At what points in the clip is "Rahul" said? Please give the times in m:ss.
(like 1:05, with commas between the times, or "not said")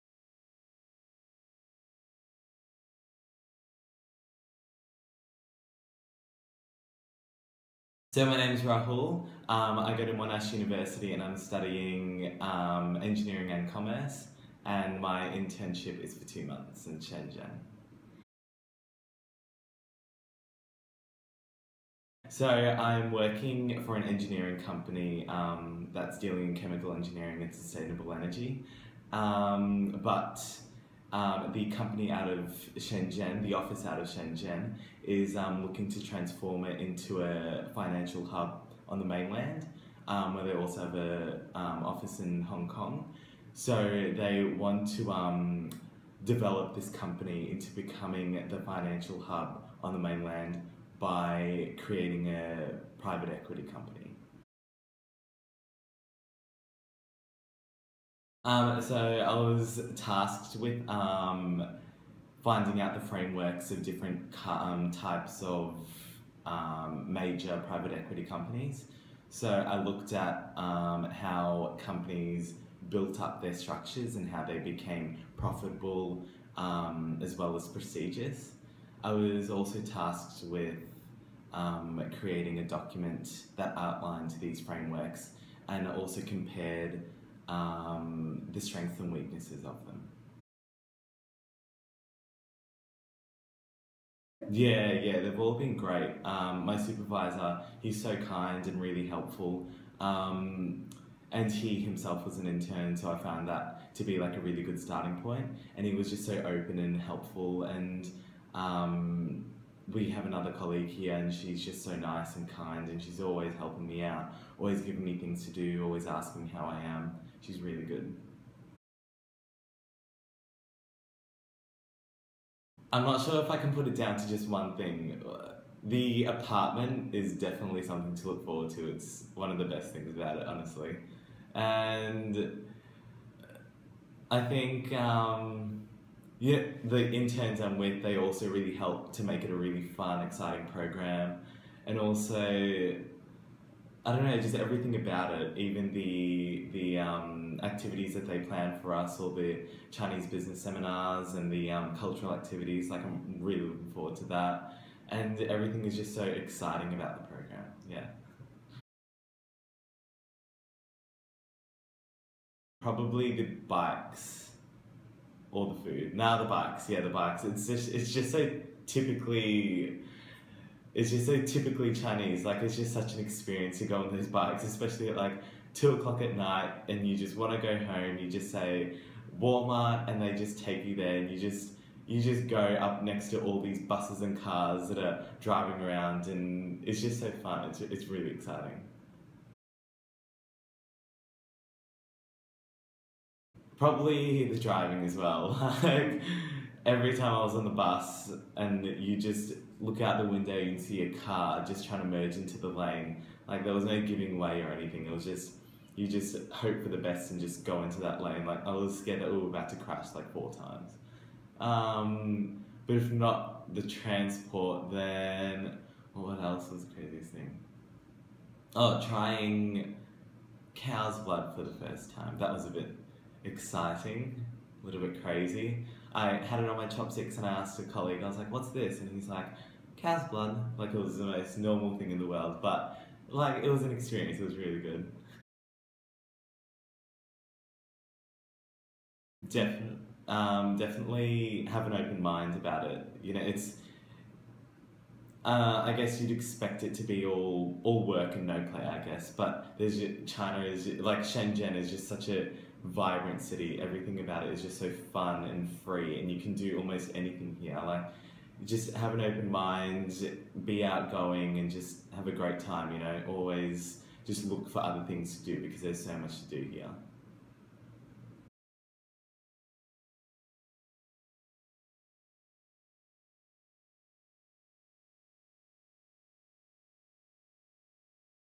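0:08.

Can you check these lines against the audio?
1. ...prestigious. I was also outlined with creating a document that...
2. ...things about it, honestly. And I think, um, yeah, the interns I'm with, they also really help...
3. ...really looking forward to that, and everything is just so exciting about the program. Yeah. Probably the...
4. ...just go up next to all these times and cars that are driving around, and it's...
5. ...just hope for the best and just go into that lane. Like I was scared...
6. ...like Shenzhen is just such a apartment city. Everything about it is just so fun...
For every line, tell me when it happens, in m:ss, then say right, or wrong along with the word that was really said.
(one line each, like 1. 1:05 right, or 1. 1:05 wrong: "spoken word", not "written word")
1. 1:17 wrong: "tasked", not "outlined"
2. 2:09 right
3. 2:33 right
4. 3:02 wrong: "buses", not "times"
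5. 3:26 right
6. 4:10 wrong: "vibrant", not "apartment".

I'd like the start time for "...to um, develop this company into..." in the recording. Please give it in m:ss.
0:44.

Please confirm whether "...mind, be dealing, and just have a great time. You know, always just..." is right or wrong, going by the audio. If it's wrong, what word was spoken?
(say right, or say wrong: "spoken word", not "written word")
wrong: "outgoing", not "dealing".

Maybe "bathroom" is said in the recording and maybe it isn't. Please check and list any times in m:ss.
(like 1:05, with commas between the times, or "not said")
not said.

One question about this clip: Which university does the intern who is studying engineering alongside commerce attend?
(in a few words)
Monash University.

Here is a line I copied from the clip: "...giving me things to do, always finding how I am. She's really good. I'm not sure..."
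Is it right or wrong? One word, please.
wrong.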